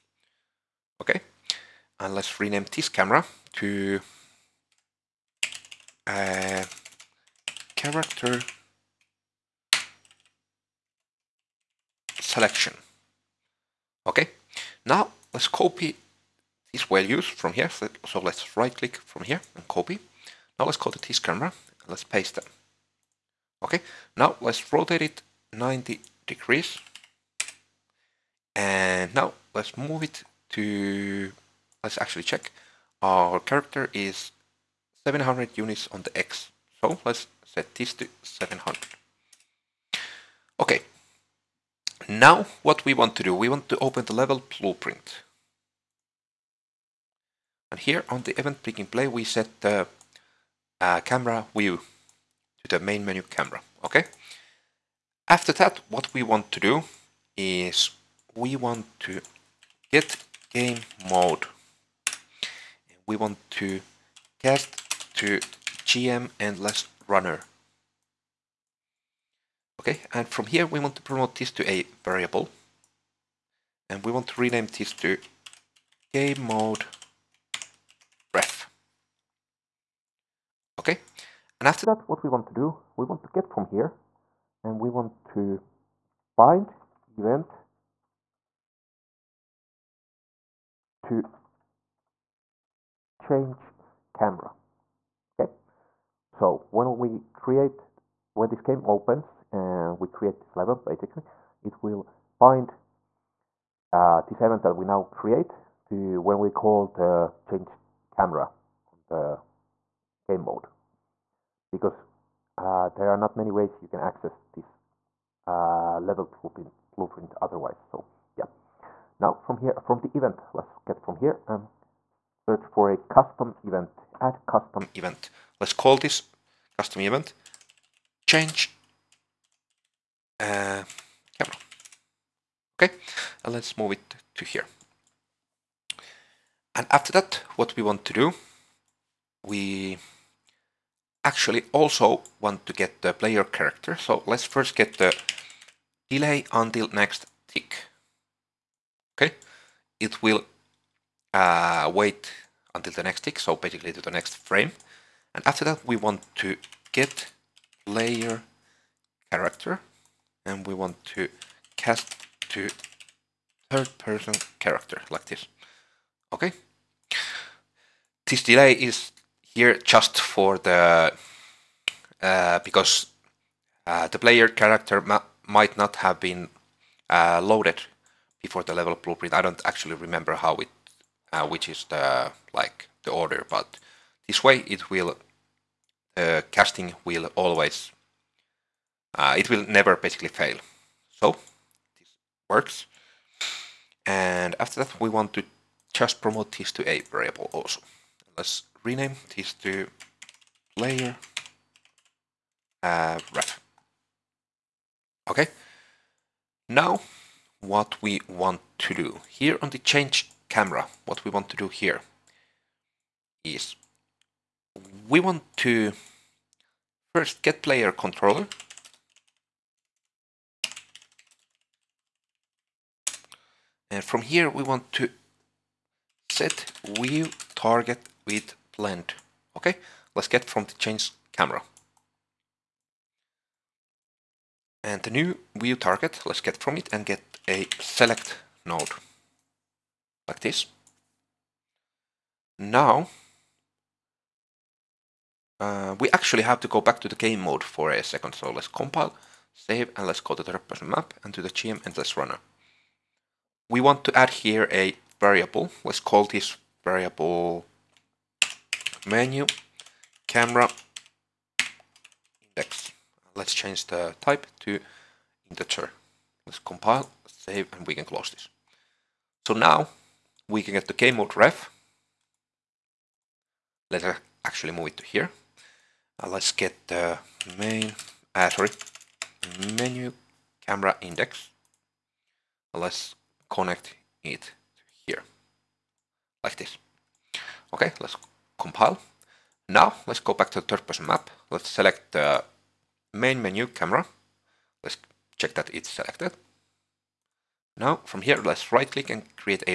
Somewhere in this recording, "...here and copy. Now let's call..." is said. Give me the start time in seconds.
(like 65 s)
19 s.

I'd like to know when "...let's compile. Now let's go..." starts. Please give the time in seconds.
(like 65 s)
287 s.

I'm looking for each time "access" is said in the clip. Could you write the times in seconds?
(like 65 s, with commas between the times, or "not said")
114 s.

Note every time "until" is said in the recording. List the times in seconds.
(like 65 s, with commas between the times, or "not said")
146 s, 152 s.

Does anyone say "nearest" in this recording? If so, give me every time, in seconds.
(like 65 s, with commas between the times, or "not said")
not said.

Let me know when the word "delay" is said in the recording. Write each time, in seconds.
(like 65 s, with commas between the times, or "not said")
146 s, 168 s.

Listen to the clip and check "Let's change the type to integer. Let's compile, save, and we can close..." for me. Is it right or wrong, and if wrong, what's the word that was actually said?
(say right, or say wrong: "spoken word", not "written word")
right.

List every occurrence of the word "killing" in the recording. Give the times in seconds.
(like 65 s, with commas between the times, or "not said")
not said.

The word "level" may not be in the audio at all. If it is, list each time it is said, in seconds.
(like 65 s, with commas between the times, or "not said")
44 s, 100 s, 116 s, 178 s.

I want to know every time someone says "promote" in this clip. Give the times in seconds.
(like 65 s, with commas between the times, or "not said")
71 s, 196 s.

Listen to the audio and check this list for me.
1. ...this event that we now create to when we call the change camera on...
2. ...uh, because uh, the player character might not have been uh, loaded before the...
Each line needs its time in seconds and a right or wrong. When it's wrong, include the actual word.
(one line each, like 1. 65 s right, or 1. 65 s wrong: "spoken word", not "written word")
1. 104 s right
2. 172 s right.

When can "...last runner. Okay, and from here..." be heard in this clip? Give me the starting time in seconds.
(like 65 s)
66 s.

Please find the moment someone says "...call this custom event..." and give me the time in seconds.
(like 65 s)
125 s.